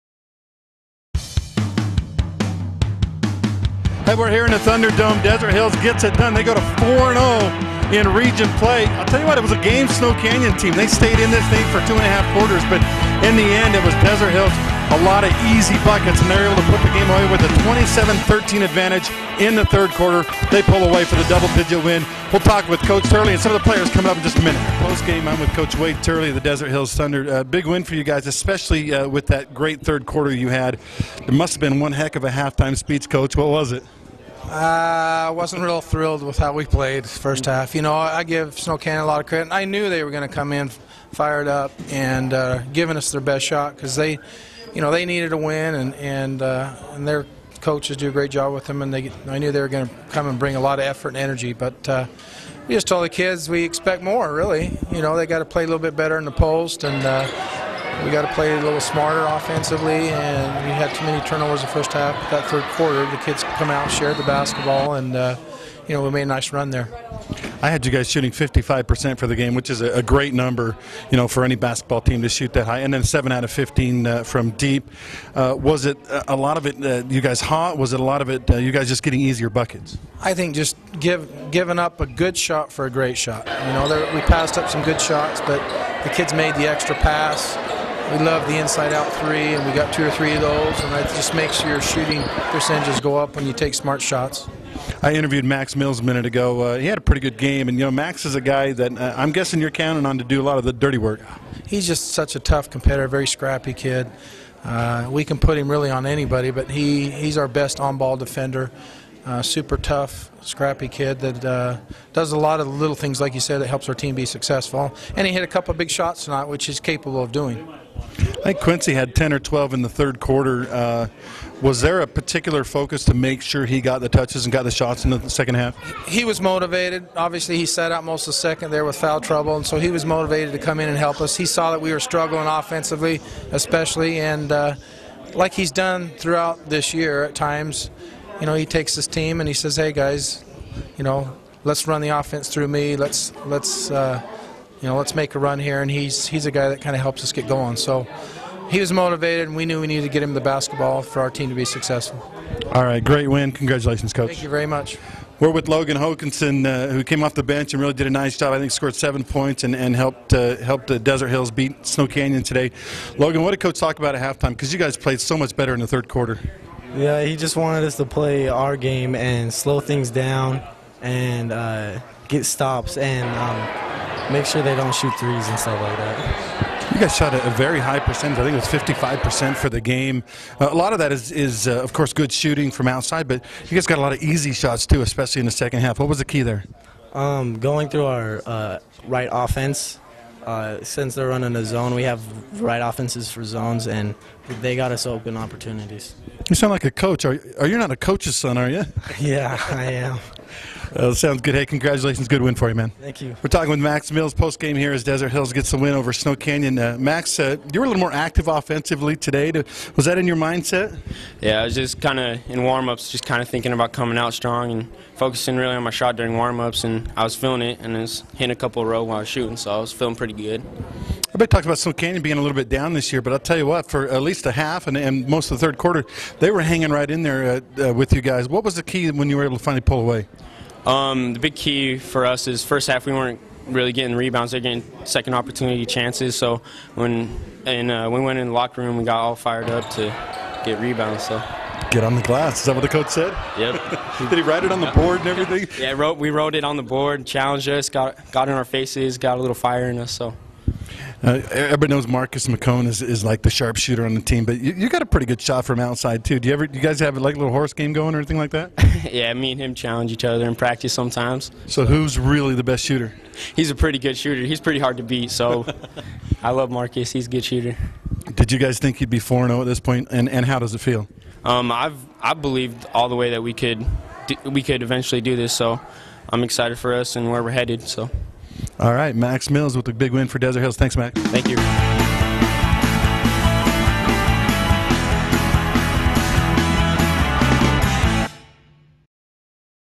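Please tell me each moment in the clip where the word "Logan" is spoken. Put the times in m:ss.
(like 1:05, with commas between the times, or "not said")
2:35, 2:43.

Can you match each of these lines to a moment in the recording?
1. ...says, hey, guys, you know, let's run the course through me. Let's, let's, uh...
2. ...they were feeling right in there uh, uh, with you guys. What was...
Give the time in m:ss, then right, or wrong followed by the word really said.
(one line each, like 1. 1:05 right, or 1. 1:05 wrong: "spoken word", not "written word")
1. 2:19 wrong: "offense", not "course"
2. 3:46 wrong: "hanging", not "feeling".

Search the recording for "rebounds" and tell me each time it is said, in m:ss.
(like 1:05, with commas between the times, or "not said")
3:54, 4:00.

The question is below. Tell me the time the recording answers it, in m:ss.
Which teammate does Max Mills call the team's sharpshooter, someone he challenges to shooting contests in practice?
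4:12.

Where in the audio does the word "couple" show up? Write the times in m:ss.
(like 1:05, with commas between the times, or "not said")
1:55, 3:38.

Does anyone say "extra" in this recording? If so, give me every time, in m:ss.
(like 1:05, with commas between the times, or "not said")
1:26.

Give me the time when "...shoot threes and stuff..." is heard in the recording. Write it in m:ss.
2:54.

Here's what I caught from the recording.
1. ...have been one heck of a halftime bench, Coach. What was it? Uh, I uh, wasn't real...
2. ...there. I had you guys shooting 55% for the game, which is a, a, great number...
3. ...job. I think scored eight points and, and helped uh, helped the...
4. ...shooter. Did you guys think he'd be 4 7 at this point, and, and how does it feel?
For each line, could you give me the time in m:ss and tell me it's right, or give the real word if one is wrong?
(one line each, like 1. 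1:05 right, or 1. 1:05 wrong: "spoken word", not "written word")
1. 0:31 wrong: "speech", not "bench"
2. 1:06 right
3. 2:38 wrong: "seven", not "eight"
4. 4:27 wrong: "0", not "7".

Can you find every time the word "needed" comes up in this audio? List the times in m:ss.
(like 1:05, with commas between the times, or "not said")
0:45, 2:29.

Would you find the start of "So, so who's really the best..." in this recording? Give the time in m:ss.
4:21.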